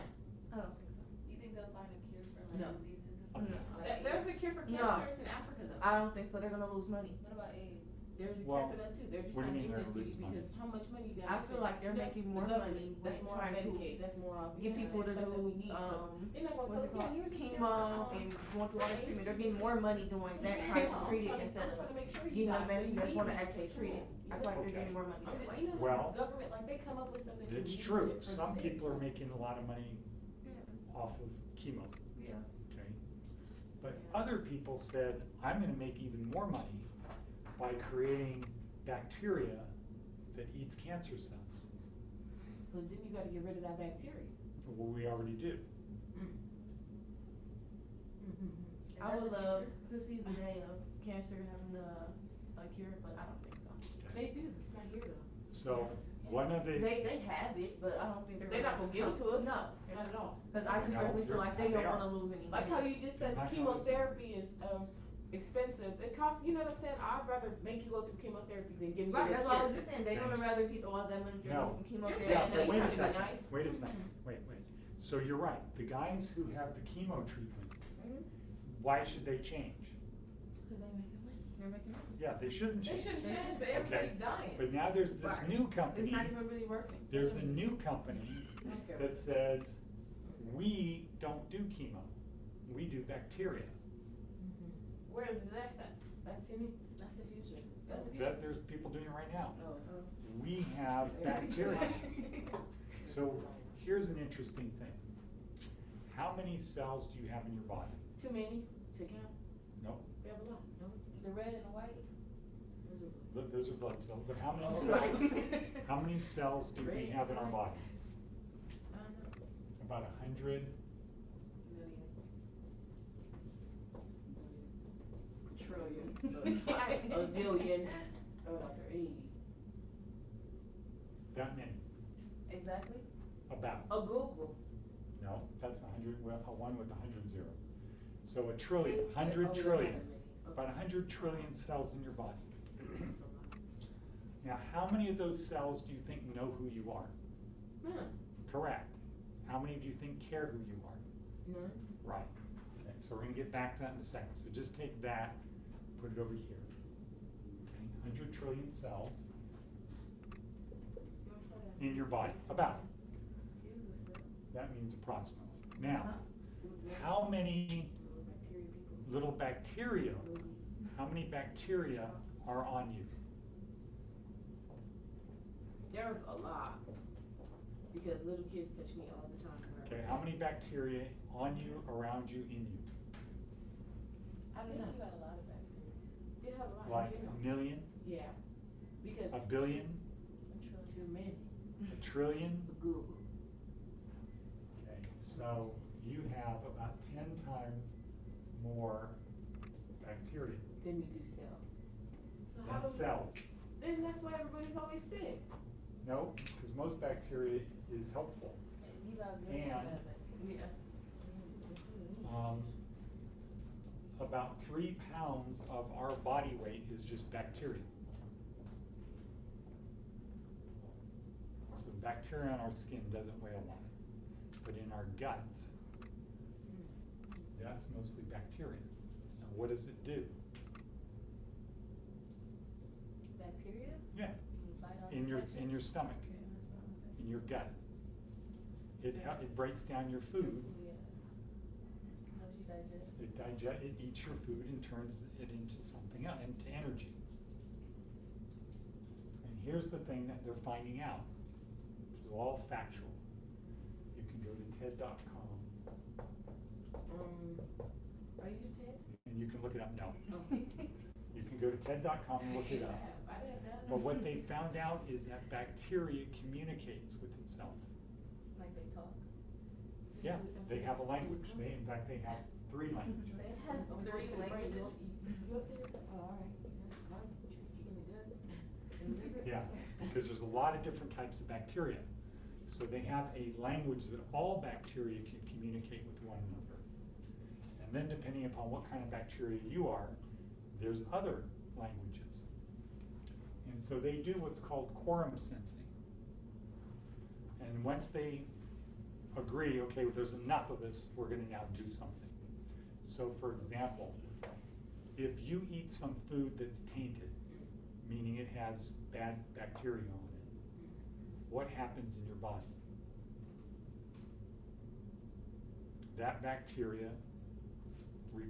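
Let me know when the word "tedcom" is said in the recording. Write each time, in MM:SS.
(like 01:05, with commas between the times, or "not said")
04:14, 04:21.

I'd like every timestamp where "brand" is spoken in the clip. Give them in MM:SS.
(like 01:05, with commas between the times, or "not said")
not said.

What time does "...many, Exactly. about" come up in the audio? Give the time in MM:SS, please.
02:11.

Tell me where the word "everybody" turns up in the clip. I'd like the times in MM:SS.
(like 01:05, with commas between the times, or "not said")
01:23, 03:24.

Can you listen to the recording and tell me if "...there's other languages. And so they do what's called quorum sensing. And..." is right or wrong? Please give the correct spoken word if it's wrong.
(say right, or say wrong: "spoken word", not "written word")
right.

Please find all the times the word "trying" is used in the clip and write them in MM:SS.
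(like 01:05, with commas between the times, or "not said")
00:13, 00:20.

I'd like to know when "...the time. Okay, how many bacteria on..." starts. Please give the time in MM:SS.
02:59.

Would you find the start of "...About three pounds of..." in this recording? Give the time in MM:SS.
03:34.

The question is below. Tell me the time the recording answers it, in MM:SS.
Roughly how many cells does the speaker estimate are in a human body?
02:20.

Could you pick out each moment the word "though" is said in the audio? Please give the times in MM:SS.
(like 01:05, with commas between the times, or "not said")
00:05, 00:55.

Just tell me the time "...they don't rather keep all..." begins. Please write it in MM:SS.
01:10.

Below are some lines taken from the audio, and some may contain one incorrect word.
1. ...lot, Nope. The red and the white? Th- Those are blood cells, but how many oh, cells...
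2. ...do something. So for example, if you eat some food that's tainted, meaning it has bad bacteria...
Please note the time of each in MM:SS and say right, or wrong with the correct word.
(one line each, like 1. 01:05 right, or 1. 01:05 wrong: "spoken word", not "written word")
1. 01:50 right
2. 05:01 right.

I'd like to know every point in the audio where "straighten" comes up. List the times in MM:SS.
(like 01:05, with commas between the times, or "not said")
not said.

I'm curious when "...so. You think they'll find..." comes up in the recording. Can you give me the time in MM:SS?
00:00.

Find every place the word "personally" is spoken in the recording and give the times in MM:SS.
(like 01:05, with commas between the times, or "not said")
01:00.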